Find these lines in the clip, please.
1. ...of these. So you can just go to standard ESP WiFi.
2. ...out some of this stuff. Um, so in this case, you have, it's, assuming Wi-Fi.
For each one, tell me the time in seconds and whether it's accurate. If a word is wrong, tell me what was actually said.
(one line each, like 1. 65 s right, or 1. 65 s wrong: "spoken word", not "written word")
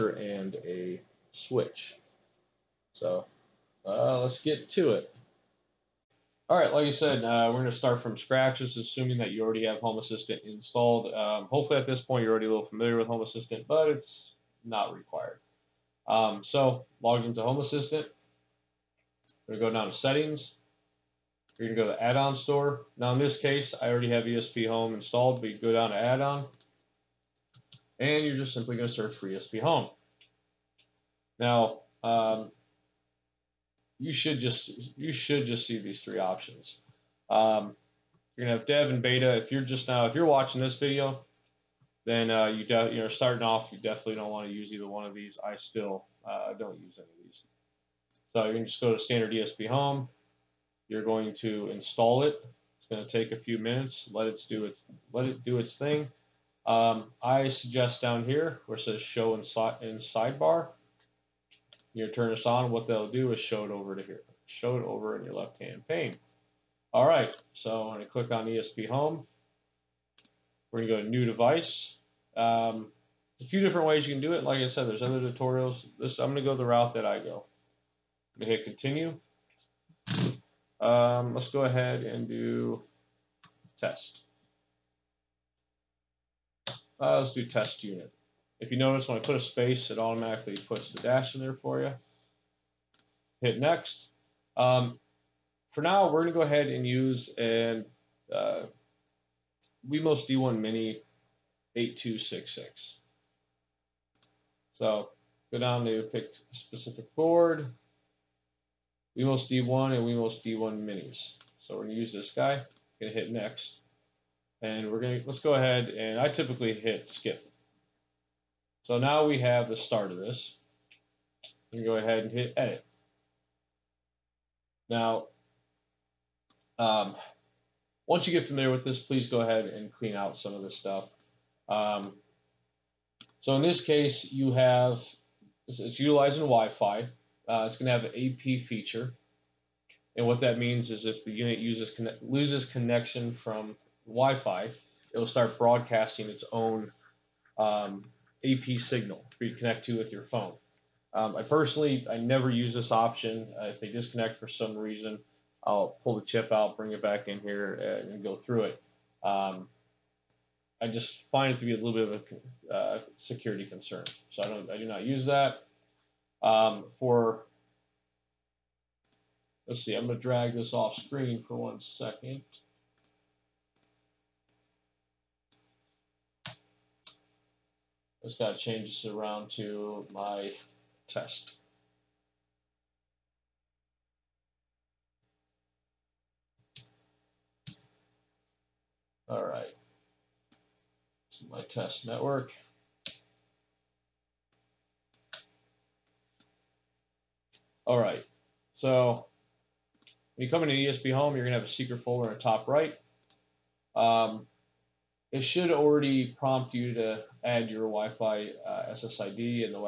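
1. 47 s wrong: "Home", not "WiFi"
2. 130 s wrong: "utilizing", not "assuming".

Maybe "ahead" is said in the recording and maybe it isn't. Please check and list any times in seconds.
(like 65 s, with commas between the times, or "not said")
81 s, 96 s, 115 s, 121 s, 129 s.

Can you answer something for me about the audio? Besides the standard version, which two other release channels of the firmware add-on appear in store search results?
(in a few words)
dev and beta.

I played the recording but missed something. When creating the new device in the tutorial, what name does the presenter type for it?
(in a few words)
test unit.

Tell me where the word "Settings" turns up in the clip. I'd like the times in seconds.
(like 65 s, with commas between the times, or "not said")
19 s.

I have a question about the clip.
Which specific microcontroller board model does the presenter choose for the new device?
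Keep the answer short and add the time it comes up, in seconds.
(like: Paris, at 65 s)
Wemos D1 Mini 8266, at 99 s.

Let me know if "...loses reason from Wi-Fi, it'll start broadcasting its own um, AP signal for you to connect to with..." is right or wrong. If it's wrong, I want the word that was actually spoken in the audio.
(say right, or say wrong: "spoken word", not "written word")
wrong: "connection", not "reason".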